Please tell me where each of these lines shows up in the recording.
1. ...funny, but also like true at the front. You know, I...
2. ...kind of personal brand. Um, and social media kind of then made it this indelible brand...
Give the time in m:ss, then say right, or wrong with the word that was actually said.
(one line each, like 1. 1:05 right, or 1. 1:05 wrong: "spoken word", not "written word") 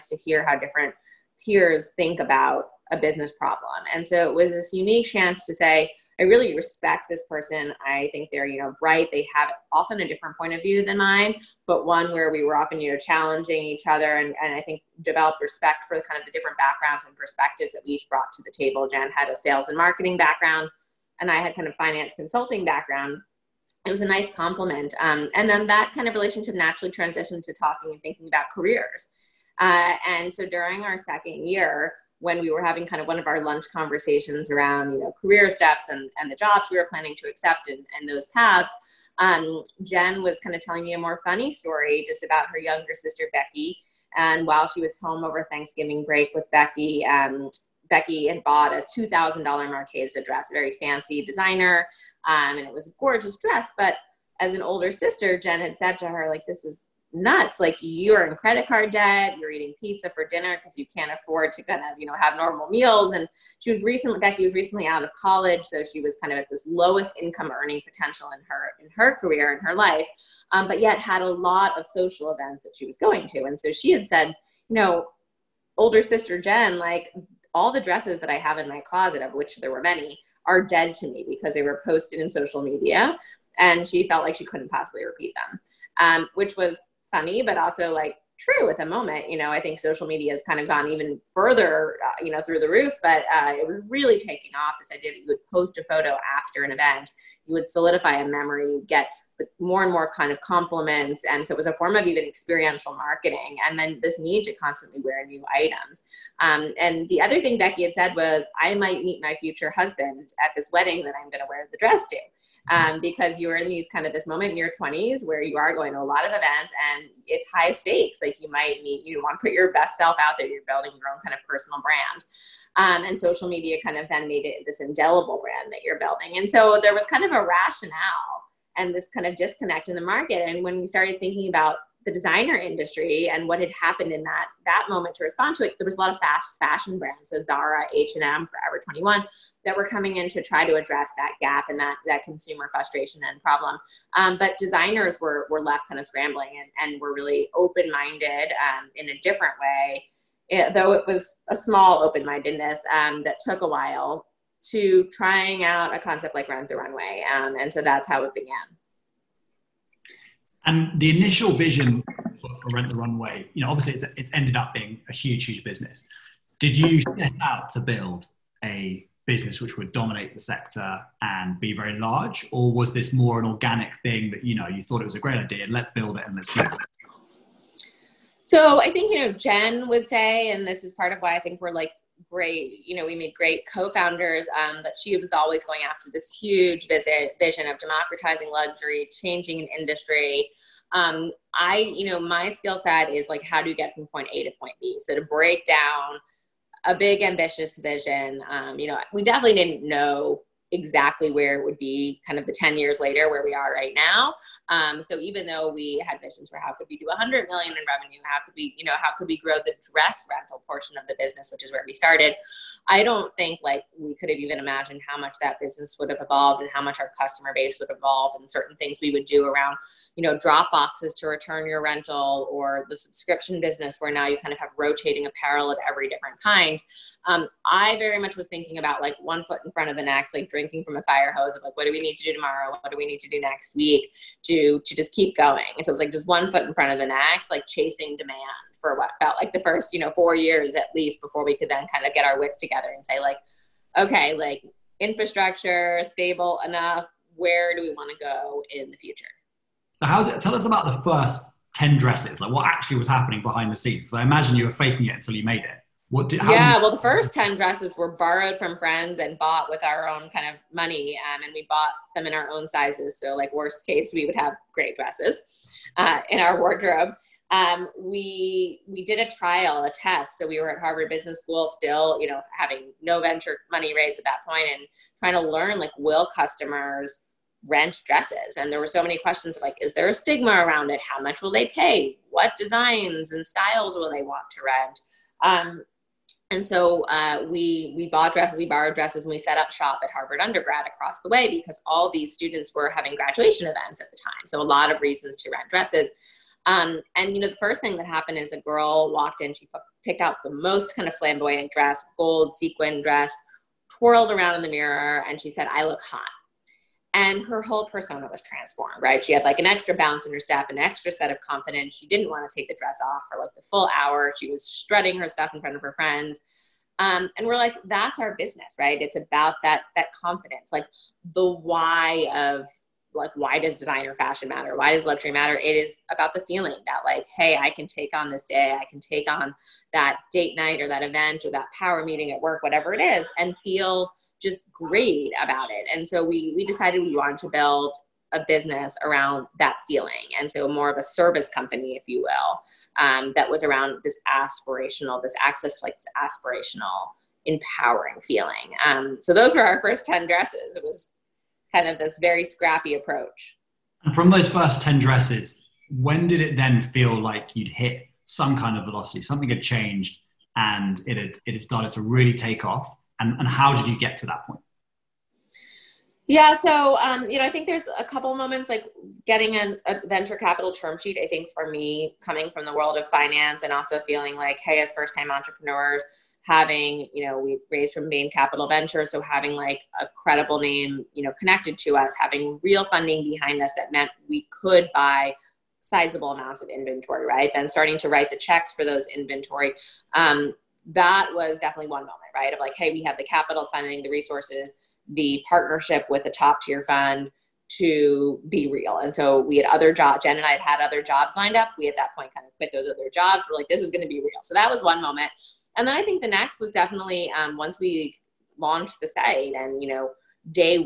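1. 1:27 wrong: "moment", not "front"
2. 2:01 right.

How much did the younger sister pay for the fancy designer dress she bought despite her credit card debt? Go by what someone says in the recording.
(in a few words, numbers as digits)
$2000.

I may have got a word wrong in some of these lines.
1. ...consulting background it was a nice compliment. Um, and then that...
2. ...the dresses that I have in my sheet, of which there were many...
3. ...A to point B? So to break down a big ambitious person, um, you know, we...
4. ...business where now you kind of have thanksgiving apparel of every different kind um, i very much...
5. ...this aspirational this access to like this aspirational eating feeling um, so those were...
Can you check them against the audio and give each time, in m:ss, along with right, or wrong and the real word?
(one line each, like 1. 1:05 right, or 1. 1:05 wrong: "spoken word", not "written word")
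1. 0:22 right
2. 1:17 wrong: "closet", not "sheet"
3. 3:14 wrong: "vision", not "person"
4. 3:43 wrong: "rotating", not "thanksgiving"
5. 5:44 wrong: "empowering", not "eating".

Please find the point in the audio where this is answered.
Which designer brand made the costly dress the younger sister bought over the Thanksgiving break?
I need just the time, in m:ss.
0:49.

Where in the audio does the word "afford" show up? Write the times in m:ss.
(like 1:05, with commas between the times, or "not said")
1:01.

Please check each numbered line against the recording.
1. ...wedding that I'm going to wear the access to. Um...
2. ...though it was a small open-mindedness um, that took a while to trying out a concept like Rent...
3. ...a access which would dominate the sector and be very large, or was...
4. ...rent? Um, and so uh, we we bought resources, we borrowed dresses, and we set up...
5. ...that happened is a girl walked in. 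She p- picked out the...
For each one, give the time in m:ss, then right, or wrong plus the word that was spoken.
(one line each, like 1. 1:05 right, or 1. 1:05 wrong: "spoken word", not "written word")
1. 1:50 wrong: "dress", not "access"
2. 2:30 right
3. 2:48 wrong: "business", not "access"
4. 4:44 wrong: "dresses", not "resources"
5. 4:57 right.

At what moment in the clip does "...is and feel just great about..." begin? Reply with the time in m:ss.
5:32.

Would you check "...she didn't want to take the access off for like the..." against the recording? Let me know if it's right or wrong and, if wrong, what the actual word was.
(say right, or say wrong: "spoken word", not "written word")
wrong: "dress", not "access".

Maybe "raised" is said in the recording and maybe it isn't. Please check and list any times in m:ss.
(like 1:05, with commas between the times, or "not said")
4:33, 6:17.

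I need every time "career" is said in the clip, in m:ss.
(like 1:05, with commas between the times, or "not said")
0:28, 0:35, 1:09.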